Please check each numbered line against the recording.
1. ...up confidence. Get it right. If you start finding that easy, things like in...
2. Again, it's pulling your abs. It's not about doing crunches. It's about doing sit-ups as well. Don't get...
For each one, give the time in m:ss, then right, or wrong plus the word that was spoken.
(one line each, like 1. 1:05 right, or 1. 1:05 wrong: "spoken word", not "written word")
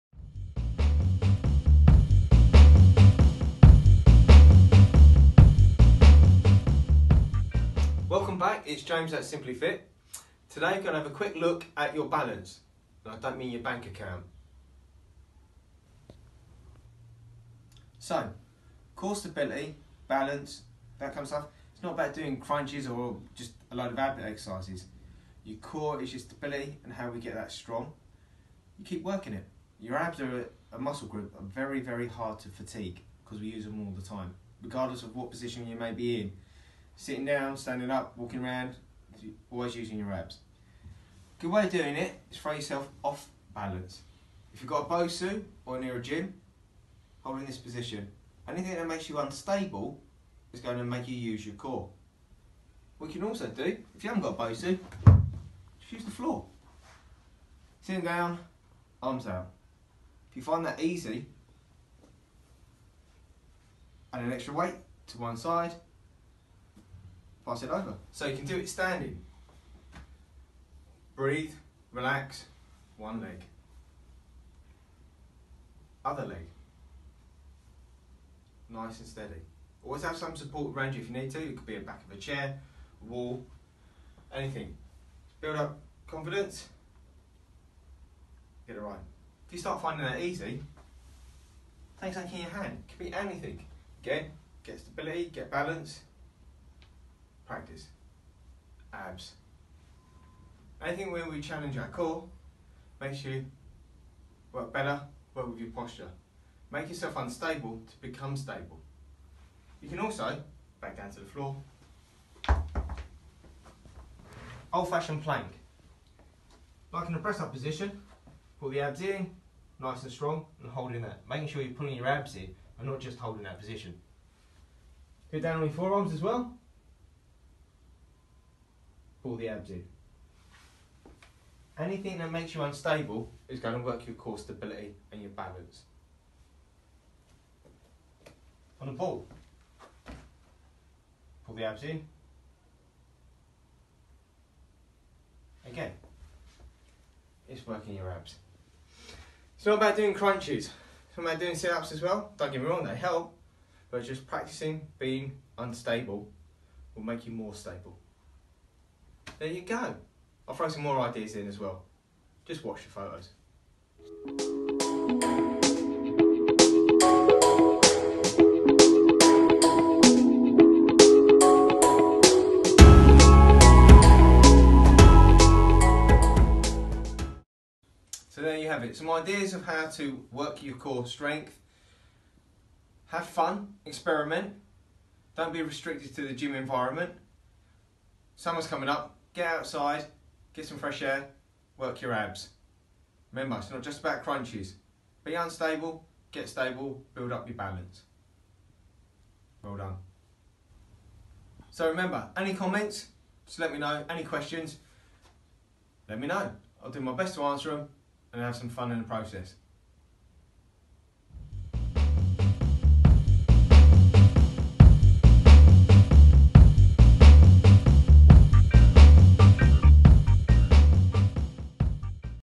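1. 1:25 right
2. 2:25 wrong: "working", not "pulling".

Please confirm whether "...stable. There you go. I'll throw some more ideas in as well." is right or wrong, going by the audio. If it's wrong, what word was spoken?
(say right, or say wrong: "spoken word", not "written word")
right.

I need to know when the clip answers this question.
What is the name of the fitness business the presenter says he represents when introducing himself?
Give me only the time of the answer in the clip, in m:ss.
0:09.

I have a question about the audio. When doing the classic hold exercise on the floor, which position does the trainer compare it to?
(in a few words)
press up position.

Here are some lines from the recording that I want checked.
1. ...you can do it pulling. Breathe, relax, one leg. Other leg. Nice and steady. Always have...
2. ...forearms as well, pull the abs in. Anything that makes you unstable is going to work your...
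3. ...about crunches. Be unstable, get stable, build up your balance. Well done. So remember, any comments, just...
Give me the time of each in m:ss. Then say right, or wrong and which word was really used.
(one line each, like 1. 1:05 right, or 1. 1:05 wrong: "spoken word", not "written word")
1. 1:08 wrong: "standing", not "pulling"
2. 2:05 right
3. 3:13 right.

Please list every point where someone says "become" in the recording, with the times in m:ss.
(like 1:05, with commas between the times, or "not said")
1:48.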